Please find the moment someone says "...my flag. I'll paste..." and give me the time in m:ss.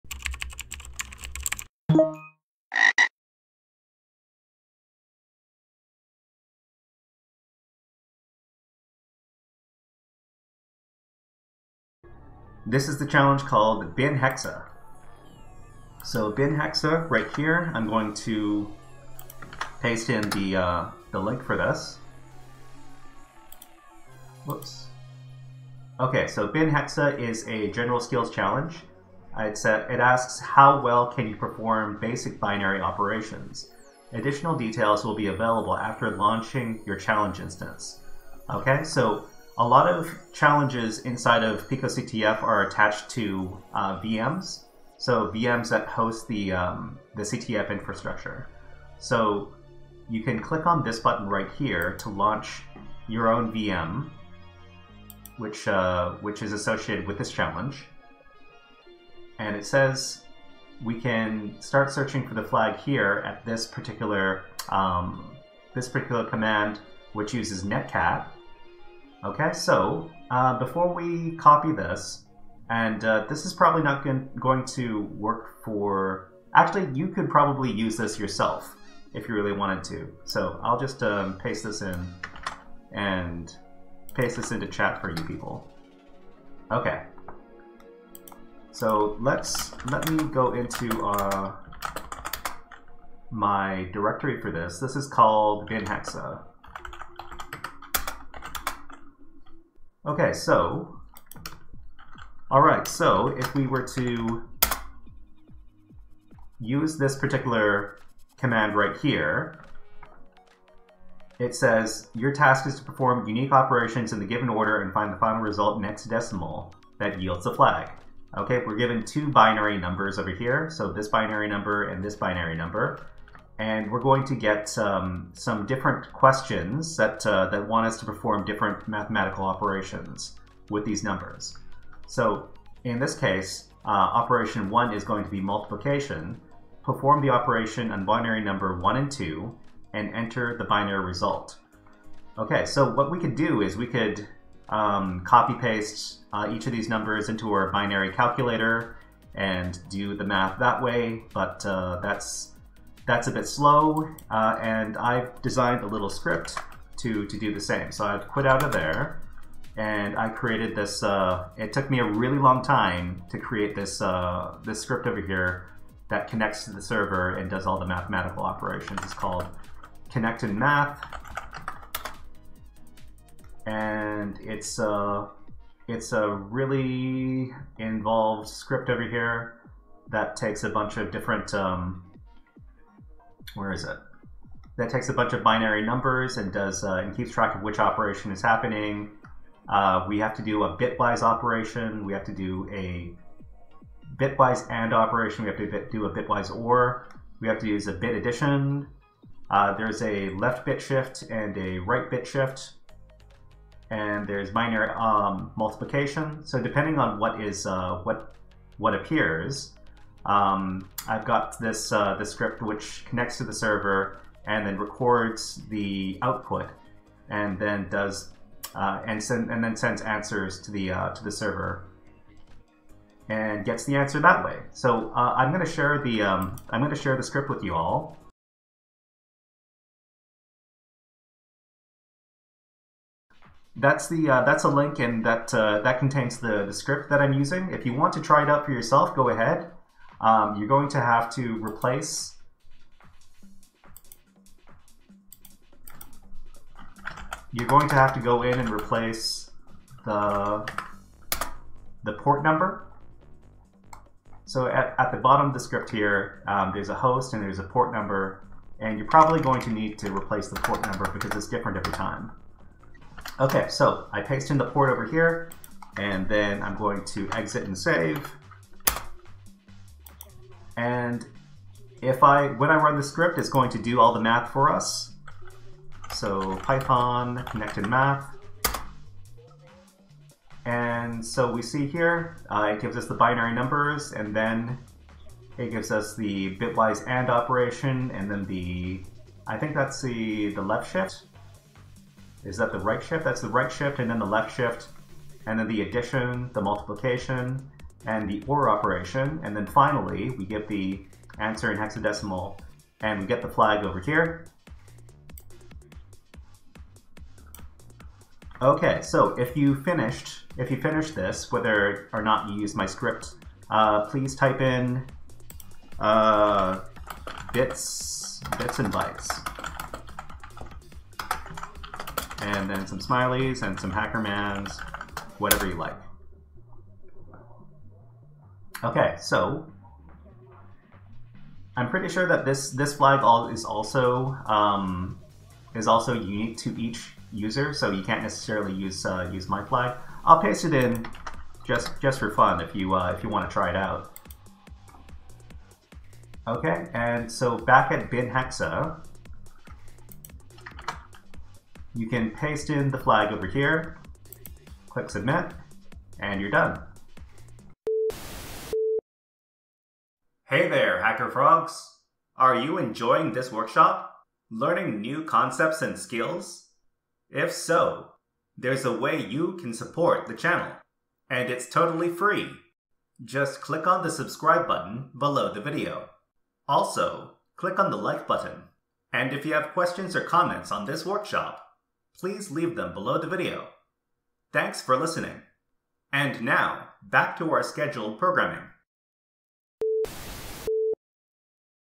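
5:39.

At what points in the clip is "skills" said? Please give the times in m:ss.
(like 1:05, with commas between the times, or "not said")
0:27, 6:05.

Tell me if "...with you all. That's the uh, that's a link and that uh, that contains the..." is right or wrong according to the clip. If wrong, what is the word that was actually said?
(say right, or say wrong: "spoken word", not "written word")
right.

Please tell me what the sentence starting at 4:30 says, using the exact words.
And if I, when I run the script, it's going to do all the math for us.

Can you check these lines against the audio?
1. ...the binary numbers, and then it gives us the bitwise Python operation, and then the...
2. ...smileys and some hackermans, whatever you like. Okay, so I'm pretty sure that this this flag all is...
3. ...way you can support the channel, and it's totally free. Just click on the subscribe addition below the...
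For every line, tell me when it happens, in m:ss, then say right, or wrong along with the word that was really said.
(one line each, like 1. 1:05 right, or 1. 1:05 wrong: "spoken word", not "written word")
1. 4:43 wrong: "AND", not "Python"
2. 5:22 right
3. 6:08 wrong: "button", not "addition".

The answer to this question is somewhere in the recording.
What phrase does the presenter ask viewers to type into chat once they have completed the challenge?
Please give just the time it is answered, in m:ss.
5:18.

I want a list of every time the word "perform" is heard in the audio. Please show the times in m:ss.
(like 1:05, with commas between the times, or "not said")
0:31, 1:52, 2:08, 2:16.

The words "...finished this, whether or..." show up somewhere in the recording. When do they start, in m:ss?
5:10.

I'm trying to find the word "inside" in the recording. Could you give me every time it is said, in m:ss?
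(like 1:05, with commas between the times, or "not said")
0:40.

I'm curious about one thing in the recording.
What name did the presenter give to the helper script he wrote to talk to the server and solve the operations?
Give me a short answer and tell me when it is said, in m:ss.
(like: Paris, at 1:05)
connect math, at 2:50.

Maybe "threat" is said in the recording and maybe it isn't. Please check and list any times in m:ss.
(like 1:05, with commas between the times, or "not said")
not said.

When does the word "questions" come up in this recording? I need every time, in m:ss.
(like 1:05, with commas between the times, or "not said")
2:06, 6:19.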